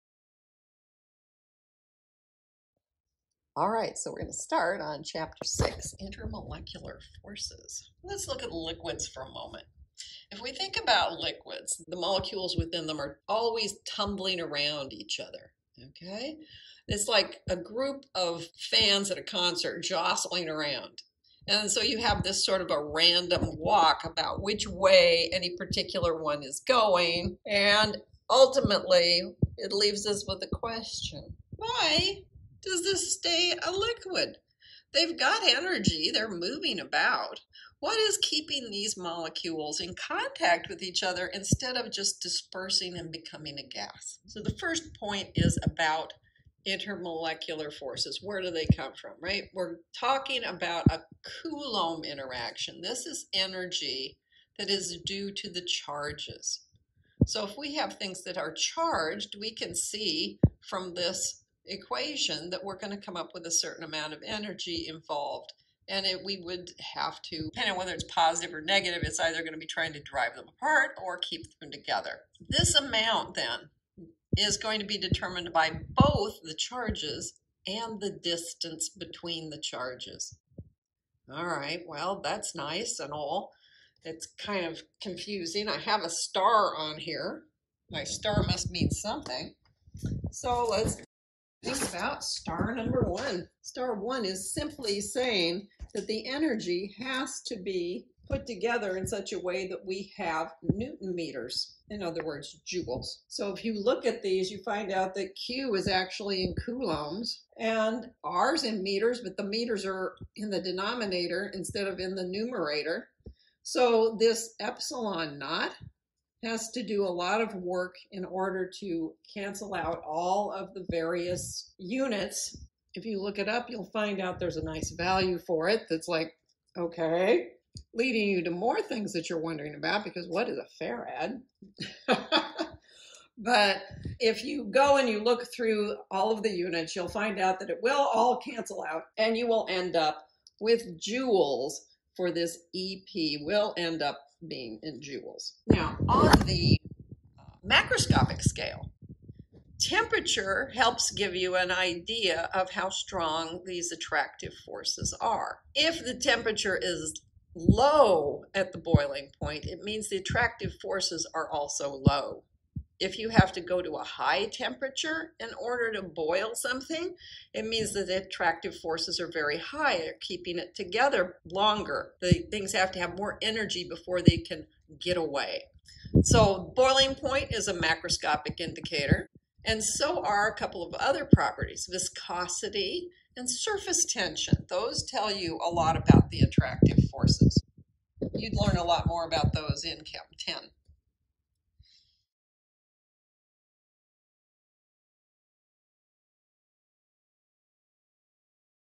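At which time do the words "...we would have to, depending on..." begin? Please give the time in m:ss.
1:06.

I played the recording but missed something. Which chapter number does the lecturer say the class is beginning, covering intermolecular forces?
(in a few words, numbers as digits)
6.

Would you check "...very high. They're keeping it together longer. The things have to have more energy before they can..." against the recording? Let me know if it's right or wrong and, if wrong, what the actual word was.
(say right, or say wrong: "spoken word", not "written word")
right.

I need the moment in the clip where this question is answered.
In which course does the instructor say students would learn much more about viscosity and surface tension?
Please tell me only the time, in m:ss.
3:10.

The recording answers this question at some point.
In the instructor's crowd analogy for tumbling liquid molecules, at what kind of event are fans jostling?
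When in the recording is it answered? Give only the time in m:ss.
0:19.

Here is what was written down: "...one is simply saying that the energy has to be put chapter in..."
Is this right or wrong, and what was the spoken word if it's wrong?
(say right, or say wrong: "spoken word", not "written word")
wrong: "together", not "chapter".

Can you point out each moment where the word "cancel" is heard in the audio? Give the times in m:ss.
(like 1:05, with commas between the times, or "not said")
1:59, 2:18.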